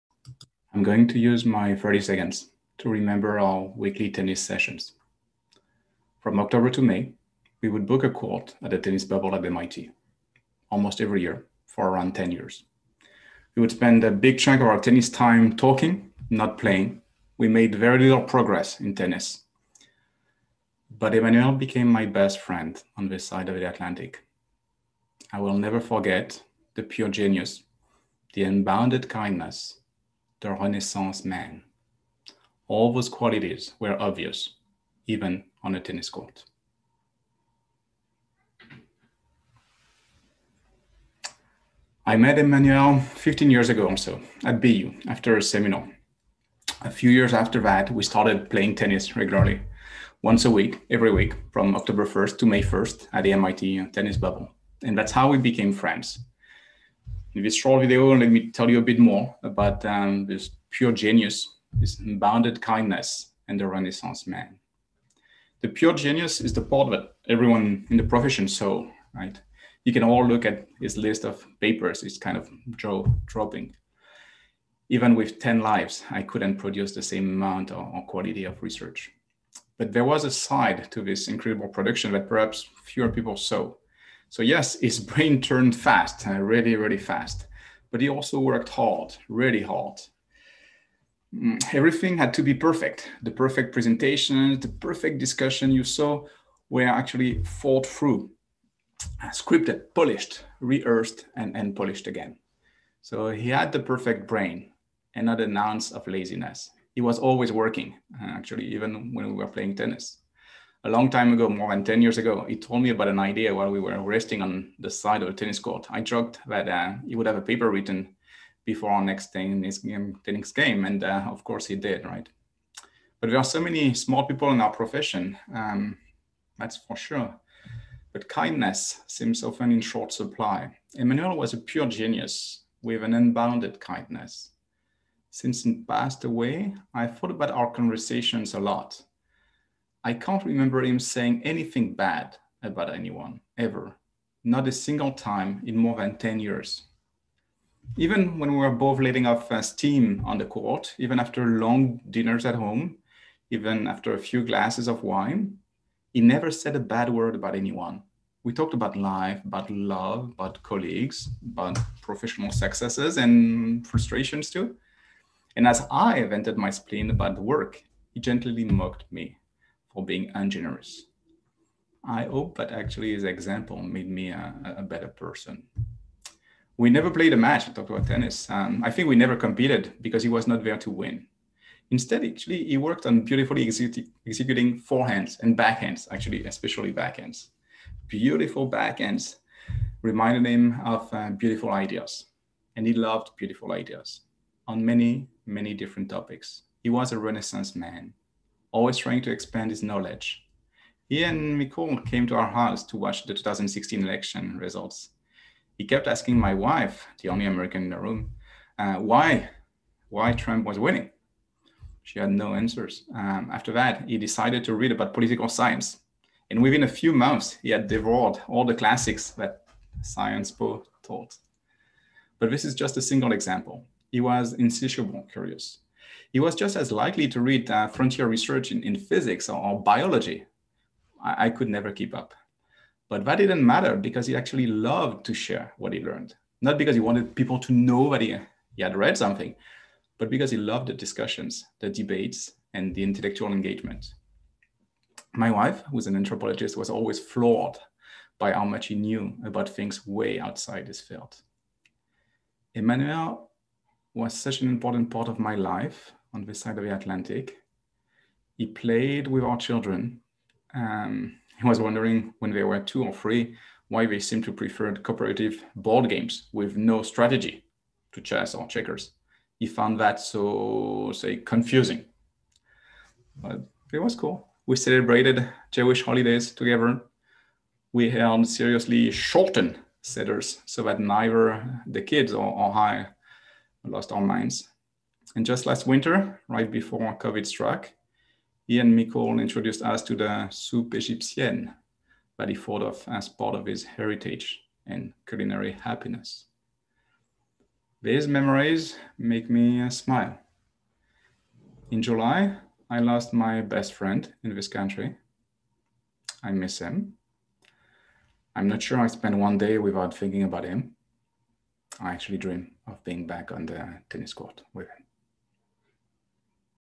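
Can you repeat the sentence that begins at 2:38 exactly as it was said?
We talked about life, about love, about colleagues, about professional successes and frustrations too.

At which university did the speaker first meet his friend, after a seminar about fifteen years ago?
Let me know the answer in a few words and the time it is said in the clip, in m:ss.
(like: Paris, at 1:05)
BU, at 0:44.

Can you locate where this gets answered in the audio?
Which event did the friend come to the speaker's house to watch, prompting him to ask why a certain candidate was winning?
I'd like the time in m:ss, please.
3:23.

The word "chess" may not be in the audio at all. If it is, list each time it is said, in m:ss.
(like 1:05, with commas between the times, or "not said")
4:28.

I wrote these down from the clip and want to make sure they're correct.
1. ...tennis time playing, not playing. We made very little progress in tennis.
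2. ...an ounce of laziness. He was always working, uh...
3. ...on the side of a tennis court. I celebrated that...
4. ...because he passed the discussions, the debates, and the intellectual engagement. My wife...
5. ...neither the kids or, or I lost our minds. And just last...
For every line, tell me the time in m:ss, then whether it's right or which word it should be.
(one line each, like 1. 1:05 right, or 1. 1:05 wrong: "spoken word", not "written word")
1. 0:14 wrong: "talking", not "playing"
2. 1:45 right
3. 1:54 wrong: "joked", not "celebrated"
4. 4:00 wrong: "loved", not "passed"
5. 4:40 right.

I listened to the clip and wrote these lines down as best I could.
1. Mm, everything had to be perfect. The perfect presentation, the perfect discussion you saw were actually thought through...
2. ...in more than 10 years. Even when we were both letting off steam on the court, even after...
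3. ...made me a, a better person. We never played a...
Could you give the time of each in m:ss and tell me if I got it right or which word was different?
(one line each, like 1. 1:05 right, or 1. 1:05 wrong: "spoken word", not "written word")
1. 1:31 right
2. 2:25 right
3. 2:53 right.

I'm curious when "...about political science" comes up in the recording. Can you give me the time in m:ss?
3:34.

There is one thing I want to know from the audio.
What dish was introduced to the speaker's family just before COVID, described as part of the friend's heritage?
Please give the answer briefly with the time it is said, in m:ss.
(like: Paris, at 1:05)
soupe égyptienne, at 4:50.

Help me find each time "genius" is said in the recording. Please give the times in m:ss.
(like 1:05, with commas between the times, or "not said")
0:27, 1:00, 1:05, 2:11.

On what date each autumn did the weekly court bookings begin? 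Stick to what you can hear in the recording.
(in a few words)
October 1st.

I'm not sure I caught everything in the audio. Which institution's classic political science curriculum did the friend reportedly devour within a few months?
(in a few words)
Sciences Po.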